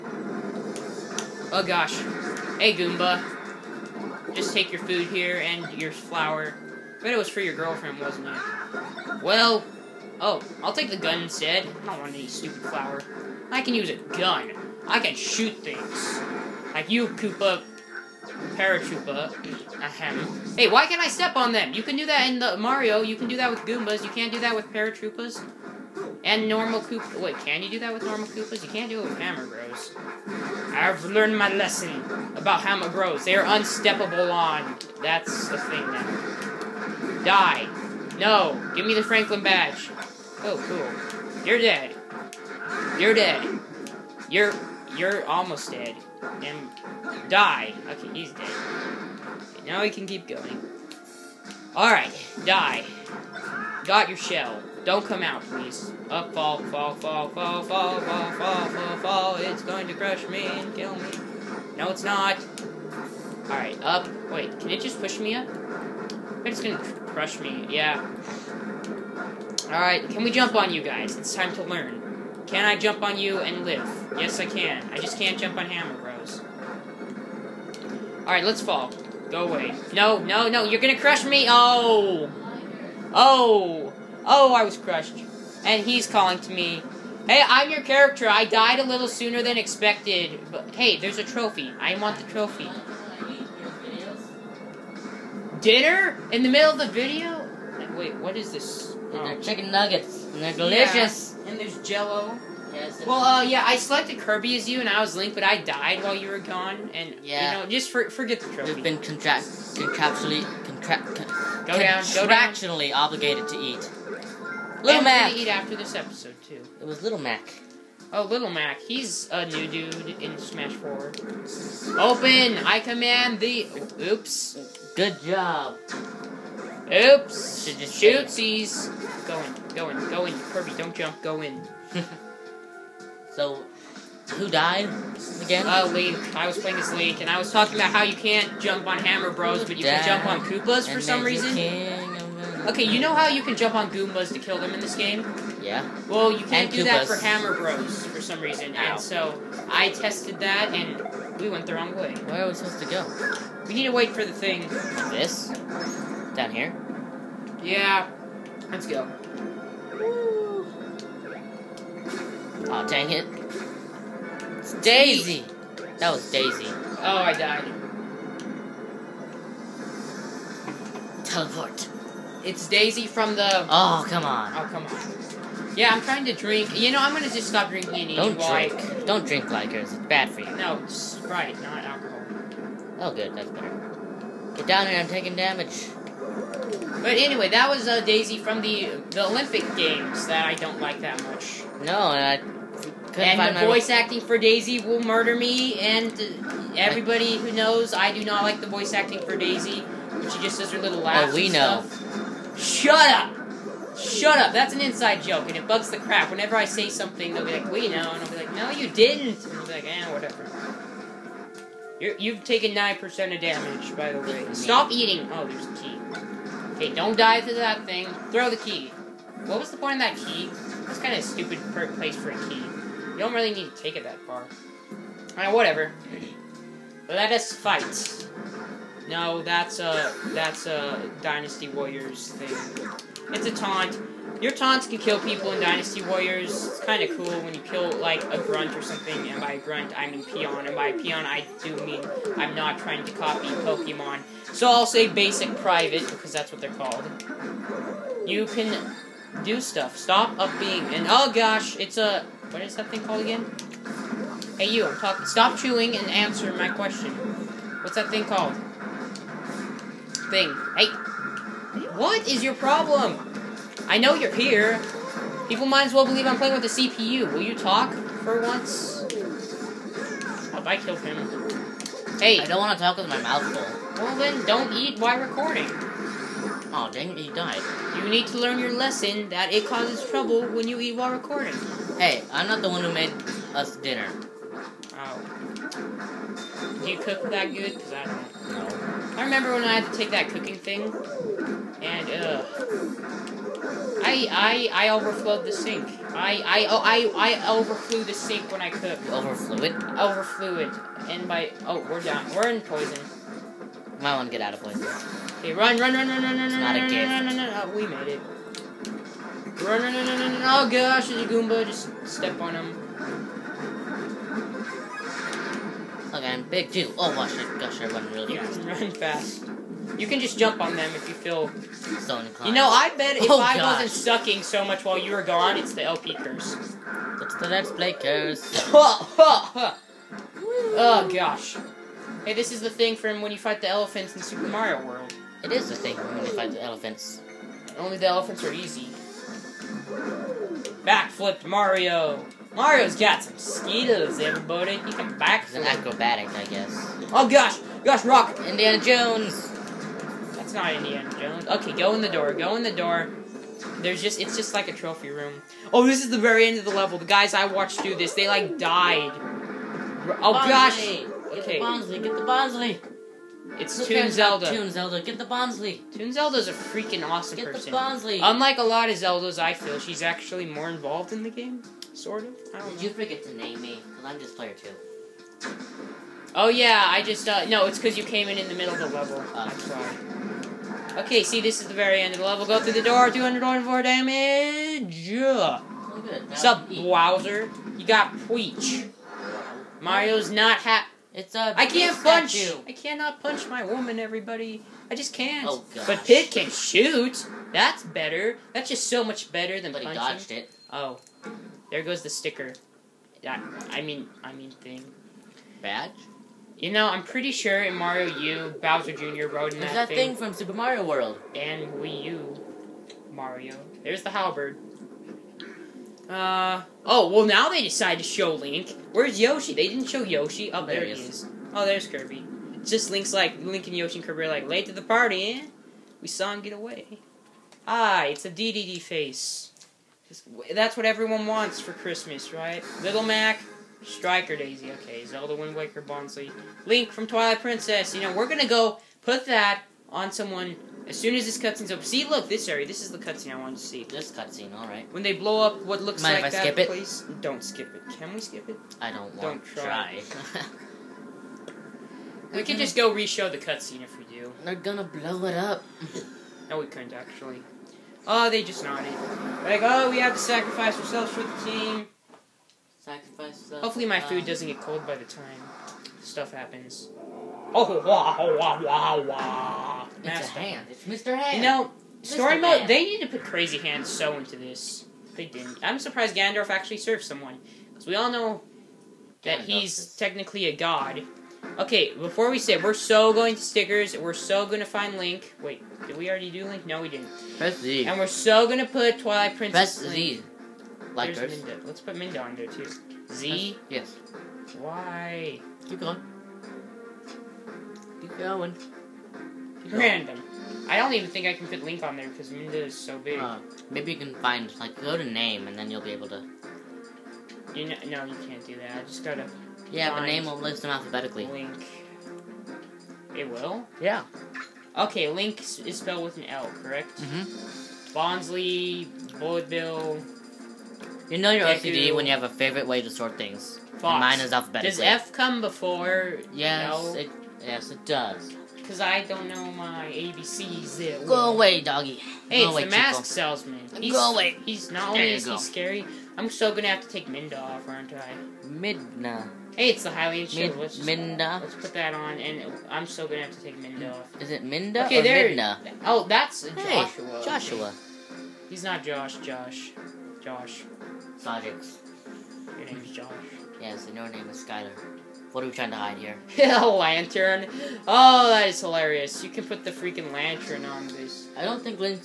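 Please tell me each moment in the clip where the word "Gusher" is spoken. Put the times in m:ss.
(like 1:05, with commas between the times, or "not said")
5:17.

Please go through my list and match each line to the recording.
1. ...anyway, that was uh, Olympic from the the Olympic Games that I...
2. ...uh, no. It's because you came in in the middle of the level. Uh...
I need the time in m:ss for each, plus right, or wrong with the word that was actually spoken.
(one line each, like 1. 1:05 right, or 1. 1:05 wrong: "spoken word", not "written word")
1. 3:07 wrong: "Daisy", not "Olympic"
2. 6:17 right.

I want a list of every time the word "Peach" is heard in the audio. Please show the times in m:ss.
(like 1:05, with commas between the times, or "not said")
6:28.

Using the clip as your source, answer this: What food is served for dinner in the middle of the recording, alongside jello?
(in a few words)
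Chicken nuggets.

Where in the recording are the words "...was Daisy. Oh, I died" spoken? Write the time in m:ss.
2:46.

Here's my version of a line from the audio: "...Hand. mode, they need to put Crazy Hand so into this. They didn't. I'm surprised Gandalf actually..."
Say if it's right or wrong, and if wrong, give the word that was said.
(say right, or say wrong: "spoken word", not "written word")
right.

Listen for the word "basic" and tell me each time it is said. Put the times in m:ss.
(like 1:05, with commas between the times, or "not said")
4:05.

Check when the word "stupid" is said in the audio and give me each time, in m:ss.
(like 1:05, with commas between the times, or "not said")
0:12, 3:41.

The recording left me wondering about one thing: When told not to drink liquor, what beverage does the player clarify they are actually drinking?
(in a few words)
Sprite.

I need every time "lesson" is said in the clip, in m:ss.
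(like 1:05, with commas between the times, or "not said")
0:31, 4:38.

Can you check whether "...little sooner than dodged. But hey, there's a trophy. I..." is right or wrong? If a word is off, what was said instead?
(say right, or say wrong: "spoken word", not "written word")
wrong: "expected", not "dodged".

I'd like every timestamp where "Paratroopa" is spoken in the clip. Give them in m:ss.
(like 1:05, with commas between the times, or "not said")
0:18, 0:24.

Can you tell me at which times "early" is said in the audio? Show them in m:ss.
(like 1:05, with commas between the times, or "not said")
not said.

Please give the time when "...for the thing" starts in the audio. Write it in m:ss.
2:34.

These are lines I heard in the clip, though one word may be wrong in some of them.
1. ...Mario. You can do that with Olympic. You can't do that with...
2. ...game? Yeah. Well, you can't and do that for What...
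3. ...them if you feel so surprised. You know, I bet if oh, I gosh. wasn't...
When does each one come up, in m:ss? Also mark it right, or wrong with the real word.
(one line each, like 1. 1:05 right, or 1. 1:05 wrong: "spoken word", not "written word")
1. 0:22 wrong: "Goombas", not "Olympic"
2. 2:24 wrong: "Hammer", not "What"
3. 5:20 wrong: "inclined", not "surprised".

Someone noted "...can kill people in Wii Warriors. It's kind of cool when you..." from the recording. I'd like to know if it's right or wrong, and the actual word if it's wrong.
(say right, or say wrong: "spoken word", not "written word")
wrong: "Dynasty", not "Wii".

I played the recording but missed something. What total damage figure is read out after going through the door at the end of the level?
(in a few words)
224.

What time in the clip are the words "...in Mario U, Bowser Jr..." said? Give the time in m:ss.
6:47.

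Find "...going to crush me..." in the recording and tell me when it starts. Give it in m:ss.
0:59.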